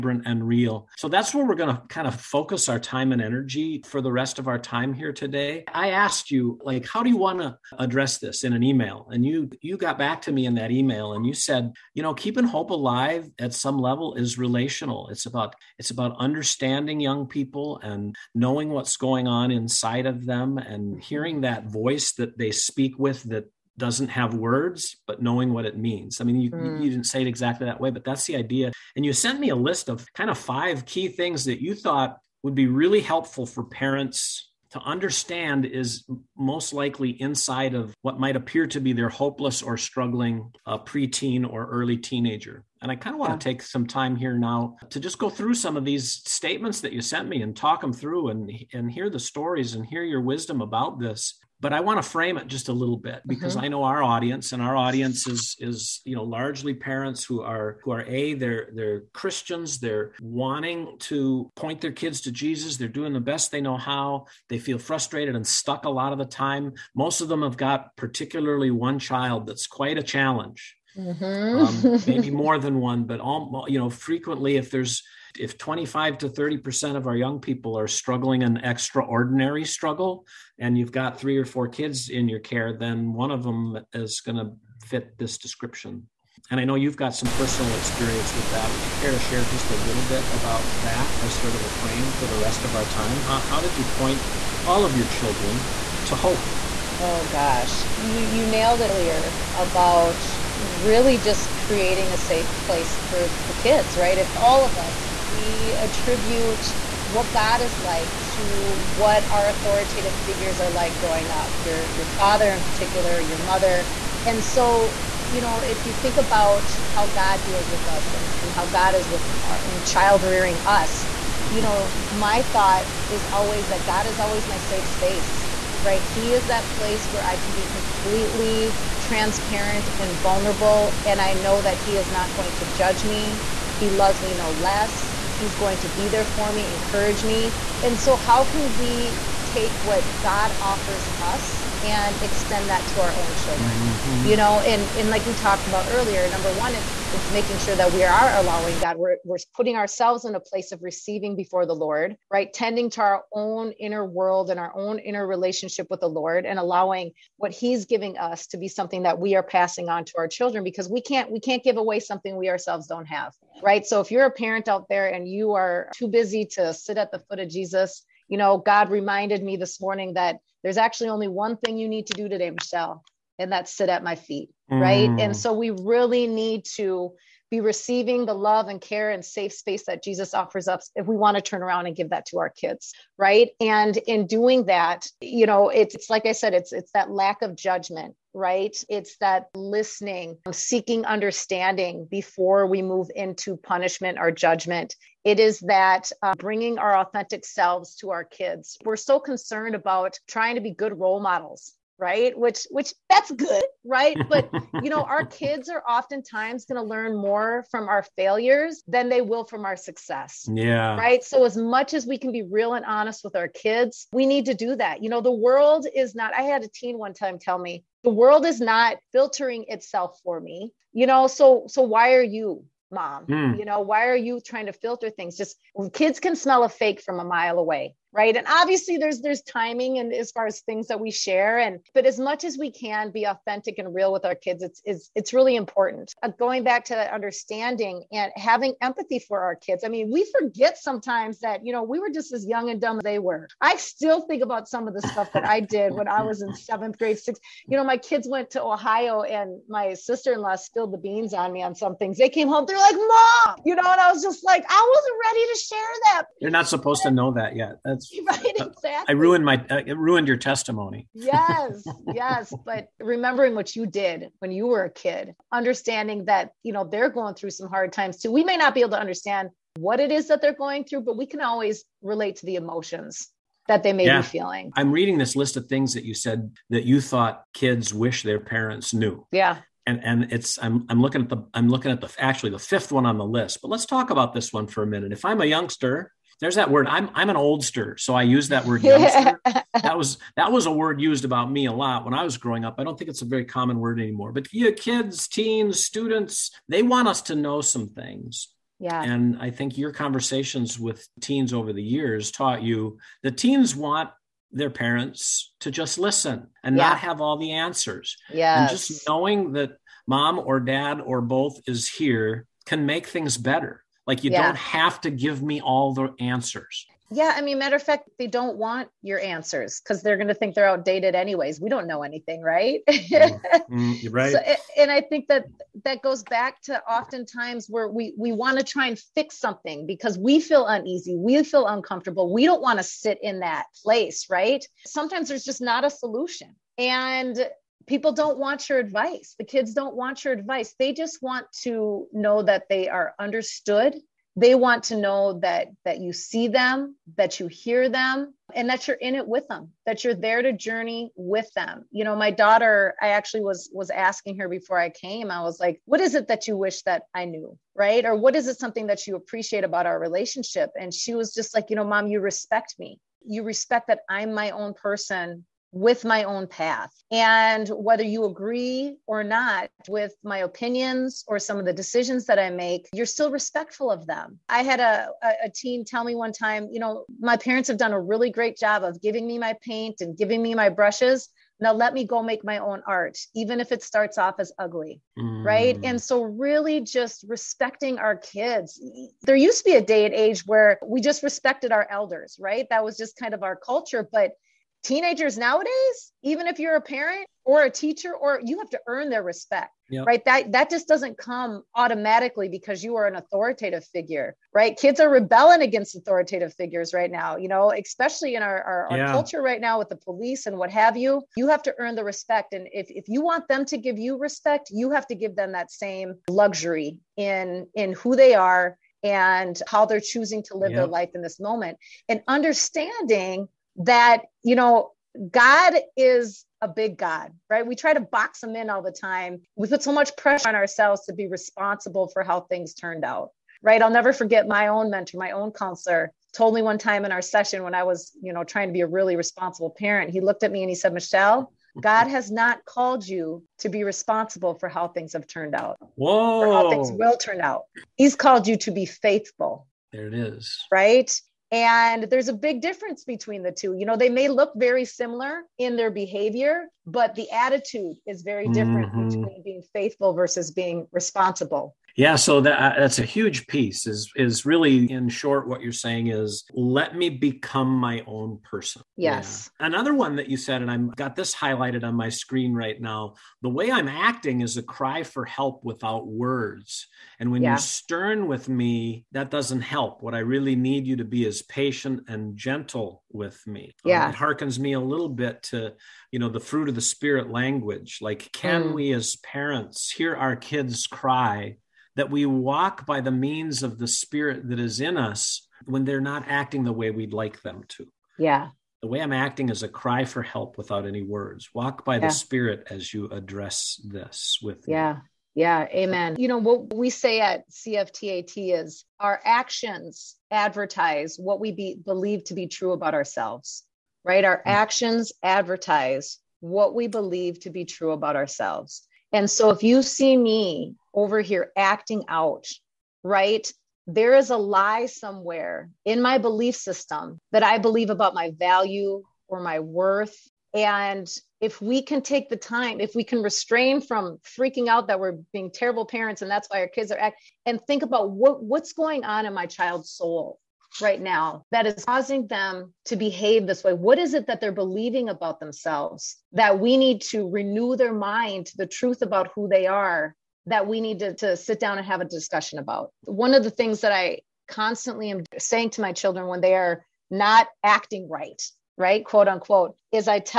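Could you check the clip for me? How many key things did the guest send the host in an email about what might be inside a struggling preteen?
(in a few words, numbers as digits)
5.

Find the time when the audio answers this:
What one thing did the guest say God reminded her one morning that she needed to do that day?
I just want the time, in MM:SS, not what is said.
02:53.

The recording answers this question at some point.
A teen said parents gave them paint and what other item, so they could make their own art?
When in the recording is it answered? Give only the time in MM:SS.
06:20.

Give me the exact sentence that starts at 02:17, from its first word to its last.
And so, how can we take what God offers us and extend that to our own children.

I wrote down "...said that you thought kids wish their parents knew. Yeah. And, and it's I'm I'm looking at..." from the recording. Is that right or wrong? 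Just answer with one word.
right.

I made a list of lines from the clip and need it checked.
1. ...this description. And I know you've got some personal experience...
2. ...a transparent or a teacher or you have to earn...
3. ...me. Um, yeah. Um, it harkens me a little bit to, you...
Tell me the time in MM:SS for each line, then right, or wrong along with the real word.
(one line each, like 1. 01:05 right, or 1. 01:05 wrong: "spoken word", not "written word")
1. 01:25 right
2. 06:36 wrong: "parent", not "transparent"
3. 08:03 right.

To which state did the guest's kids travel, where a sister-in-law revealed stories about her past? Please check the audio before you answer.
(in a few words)
Ohio.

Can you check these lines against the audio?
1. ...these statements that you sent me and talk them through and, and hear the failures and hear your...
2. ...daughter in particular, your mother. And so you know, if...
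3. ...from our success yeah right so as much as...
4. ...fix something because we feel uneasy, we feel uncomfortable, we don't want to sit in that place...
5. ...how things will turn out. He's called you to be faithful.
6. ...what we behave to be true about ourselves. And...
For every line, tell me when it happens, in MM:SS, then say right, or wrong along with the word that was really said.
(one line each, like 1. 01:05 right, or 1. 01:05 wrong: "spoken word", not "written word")
1. 00:45 wrong: "stories", not "failures"
2. 01:52 wrong: "father", not "daughter"
3. 03:29 right
4. 05:28 right
5. 07:26 right
6. 08:36 wrong: "believe", not "behave".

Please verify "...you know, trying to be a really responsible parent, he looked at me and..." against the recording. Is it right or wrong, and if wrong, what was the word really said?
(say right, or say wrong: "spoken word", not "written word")
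right.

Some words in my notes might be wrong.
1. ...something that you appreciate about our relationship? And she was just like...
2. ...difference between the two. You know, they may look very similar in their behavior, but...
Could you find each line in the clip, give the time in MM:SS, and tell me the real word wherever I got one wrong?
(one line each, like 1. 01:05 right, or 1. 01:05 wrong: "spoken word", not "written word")
1. 05:58 right
2. 07:32 right.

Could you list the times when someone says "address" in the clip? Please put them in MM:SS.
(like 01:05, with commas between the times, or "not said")
00:07, 08:23.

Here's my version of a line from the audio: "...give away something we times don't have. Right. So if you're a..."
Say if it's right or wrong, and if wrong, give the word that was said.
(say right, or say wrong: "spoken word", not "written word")
wrong: "ourselves", not "times".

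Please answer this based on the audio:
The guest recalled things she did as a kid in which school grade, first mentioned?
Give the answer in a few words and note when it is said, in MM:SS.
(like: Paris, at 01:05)
Seventh grade, at 04:06.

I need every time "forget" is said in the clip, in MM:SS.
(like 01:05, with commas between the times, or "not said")
04:00, 07:14.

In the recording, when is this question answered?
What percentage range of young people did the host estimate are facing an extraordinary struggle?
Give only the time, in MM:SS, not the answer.
01:15.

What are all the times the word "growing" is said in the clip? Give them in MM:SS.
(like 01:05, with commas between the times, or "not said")
01:50, 04:52.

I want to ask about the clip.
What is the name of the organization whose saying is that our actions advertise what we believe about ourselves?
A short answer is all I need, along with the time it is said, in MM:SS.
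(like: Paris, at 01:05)
CFTAT, at 08:27.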